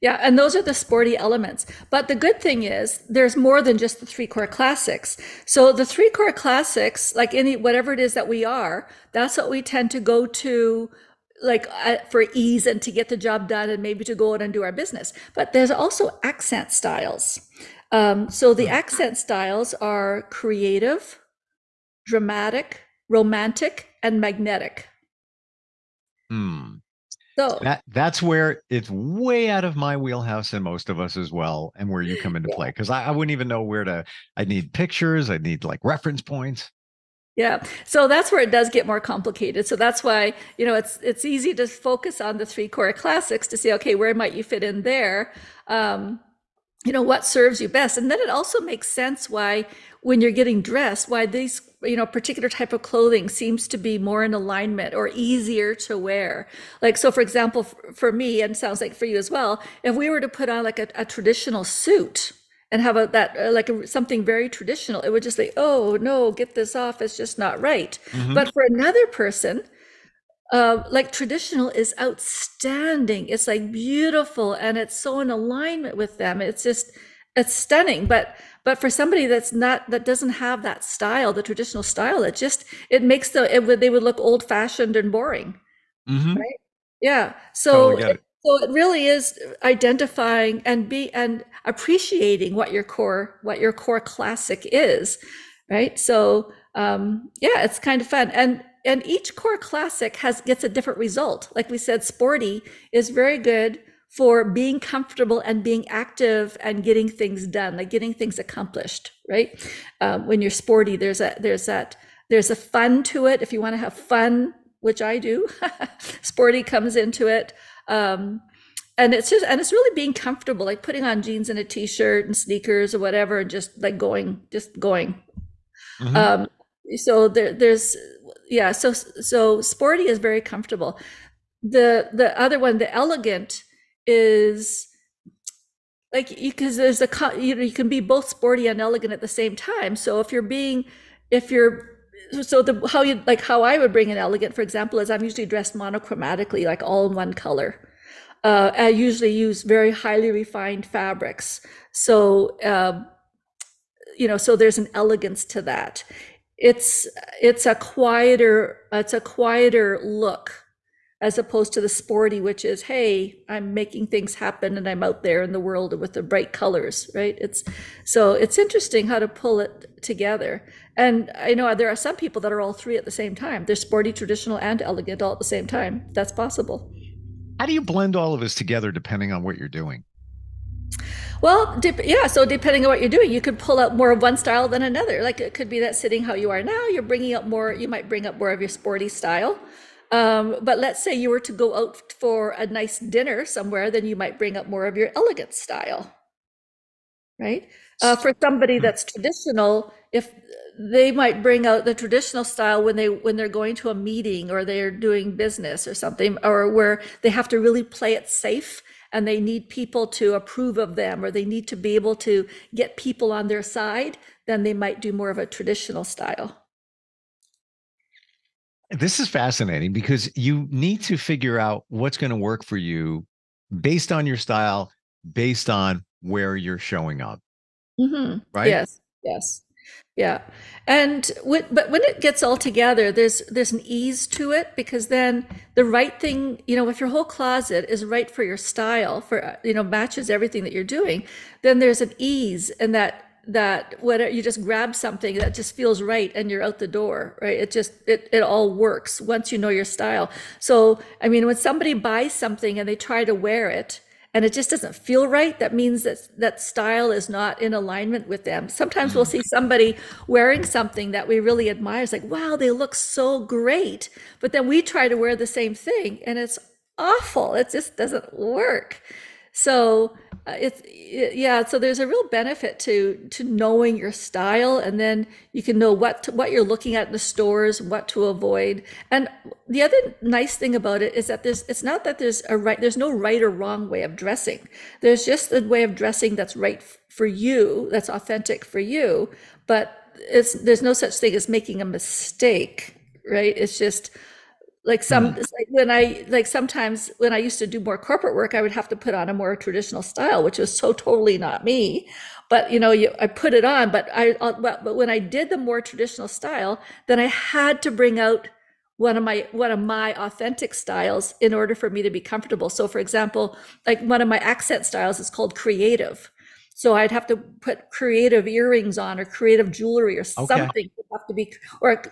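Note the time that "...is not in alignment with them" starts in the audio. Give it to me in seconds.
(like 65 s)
257 s.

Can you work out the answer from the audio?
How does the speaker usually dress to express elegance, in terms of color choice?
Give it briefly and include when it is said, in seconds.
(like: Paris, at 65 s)
Monochromatically, at 145 s.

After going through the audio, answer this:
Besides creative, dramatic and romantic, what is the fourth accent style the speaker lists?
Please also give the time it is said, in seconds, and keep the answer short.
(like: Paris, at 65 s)
Magnetic, at 24 s.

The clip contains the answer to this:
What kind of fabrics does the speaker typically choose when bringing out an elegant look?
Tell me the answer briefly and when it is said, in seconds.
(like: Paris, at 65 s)
Highly refined fabrics, at 149 s.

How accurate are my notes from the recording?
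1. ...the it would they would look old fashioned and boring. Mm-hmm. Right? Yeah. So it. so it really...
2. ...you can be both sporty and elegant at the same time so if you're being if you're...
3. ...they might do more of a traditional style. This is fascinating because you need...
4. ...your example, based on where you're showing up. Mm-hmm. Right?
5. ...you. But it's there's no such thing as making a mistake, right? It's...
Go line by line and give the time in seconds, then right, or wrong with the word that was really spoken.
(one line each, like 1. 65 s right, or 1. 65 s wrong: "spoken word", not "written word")
1. 83 s right
2. 137 s right
3. 214 s right
4. 224 s wrong: "style", not "example"
5. 288 s right.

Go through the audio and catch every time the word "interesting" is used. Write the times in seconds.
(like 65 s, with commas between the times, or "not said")
168 s.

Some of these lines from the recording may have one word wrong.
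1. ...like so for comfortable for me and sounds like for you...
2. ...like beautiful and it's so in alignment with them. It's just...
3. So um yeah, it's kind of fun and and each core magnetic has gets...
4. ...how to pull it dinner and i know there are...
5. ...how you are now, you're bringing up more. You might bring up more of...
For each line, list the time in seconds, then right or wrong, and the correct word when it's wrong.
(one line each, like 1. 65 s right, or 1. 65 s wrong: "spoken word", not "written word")
1. 56 s wrong: "example", not "comfortable"
2. 73 s right
3. 95 s wrong: "classic", not "magnetic"
4. 169 s wrong: "together", not "dinner"
5. 186 s right.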